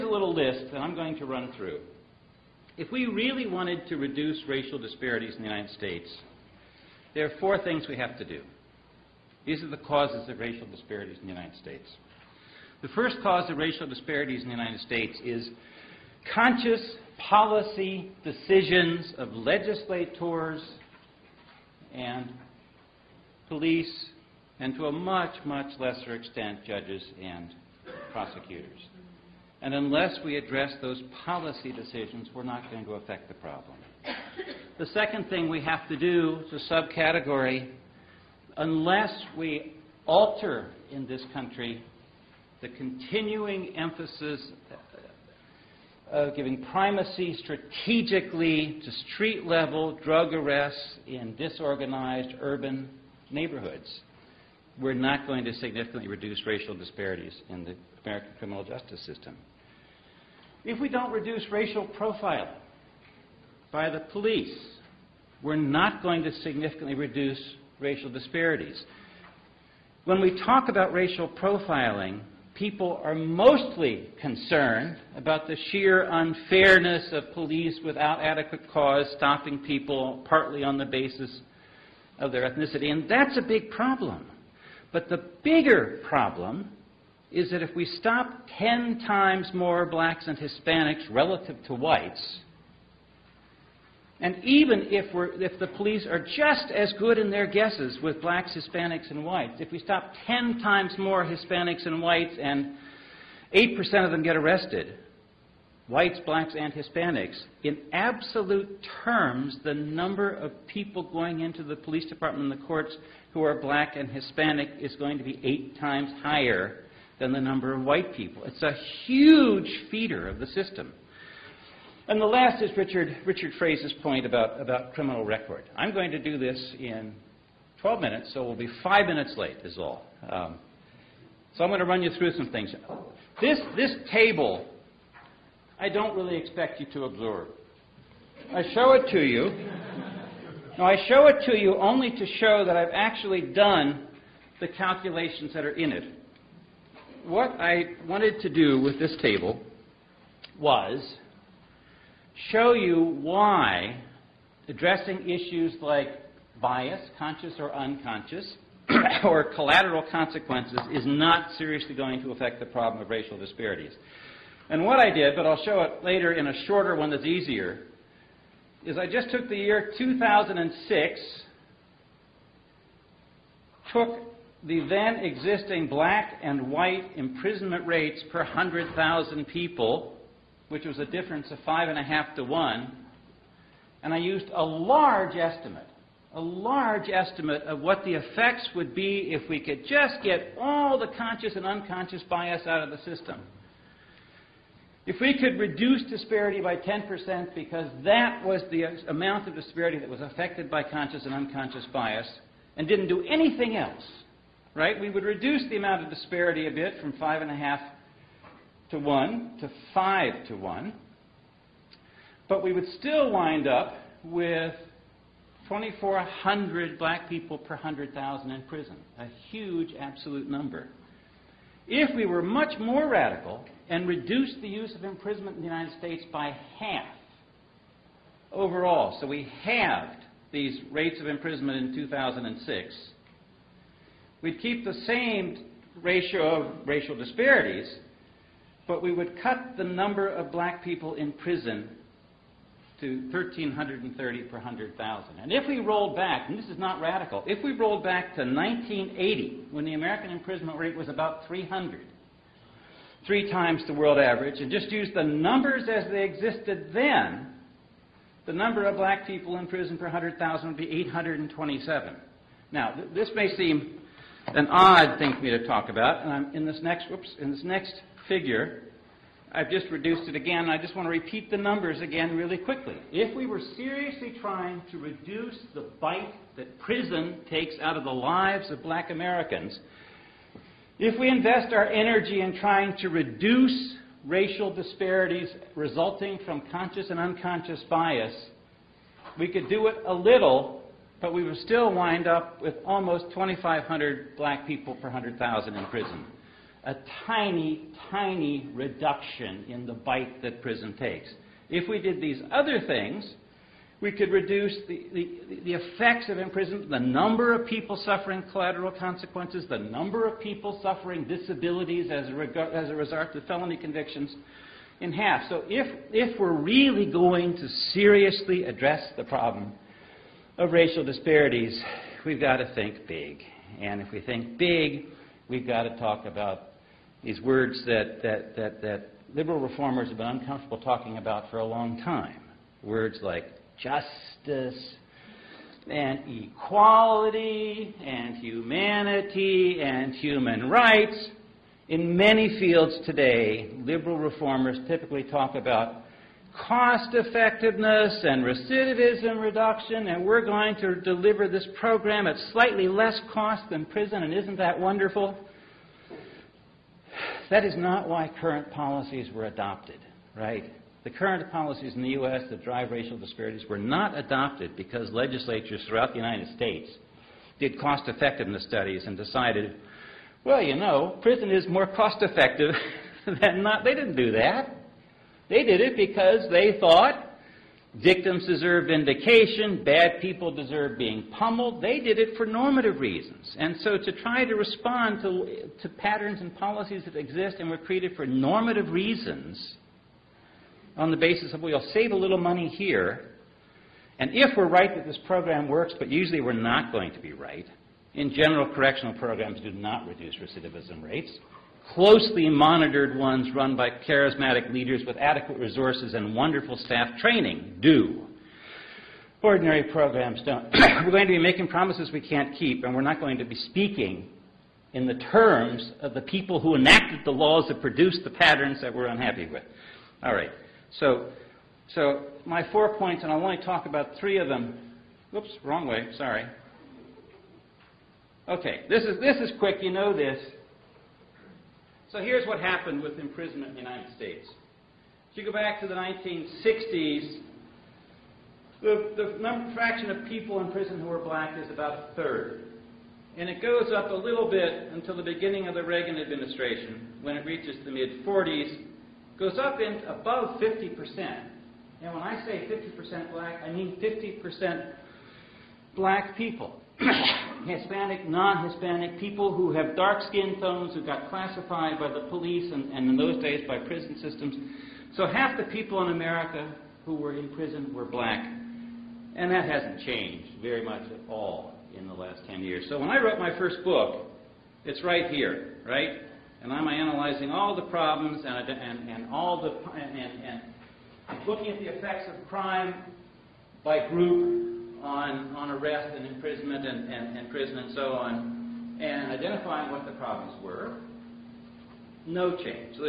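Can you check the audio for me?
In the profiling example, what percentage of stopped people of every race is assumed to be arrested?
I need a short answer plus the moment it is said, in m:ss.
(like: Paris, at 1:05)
8%, at 1:43.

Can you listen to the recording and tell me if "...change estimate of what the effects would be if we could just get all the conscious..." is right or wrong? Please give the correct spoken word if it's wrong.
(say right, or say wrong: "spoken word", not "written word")
wrong: "large", not "change".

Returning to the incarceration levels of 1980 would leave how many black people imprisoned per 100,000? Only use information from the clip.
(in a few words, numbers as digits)
827.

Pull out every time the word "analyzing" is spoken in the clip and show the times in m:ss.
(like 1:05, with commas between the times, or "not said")
7:56.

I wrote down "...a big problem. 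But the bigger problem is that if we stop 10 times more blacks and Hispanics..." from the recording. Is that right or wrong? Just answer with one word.
right.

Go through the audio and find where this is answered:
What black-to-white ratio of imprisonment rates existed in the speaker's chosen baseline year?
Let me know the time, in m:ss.
3:01.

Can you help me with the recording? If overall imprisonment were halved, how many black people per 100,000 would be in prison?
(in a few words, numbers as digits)
1,330.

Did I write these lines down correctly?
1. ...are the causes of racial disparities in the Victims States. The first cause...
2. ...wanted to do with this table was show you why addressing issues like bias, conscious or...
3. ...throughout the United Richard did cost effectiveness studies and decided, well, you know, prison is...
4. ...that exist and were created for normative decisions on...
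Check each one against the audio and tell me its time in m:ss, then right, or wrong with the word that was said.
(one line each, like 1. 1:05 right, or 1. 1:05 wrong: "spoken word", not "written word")
1. 0:09 wrong: "United", not "Victims"
2. 2:28 right
3. 6:05 wrong: "States", not "Richard"
4. 6:27 wrong: "reasons", not "decisions".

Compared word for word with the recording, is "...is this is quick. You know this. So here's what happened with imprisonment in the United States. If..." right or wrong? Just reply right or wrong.
right.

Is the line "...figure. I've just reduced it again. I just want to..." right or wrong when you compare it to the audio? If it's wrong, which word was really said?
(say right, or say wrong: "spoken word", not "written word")
right.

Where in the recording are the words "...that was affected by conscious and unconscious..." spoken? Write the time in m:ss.
3:19.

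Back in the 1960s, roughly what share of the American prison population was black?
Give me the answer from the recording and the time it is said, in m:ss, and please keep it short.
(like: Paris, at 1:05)
About a third, at 7:21.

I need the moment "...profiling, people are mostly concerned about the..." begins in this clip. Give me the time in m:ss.
1:11.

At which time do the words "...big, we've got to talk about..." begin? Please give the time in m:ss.
5:24.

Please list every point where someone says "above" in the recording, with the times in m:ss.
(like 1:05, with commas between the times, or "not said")
7:30.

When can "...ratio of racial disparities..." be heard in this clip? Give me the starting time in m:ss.
3:56.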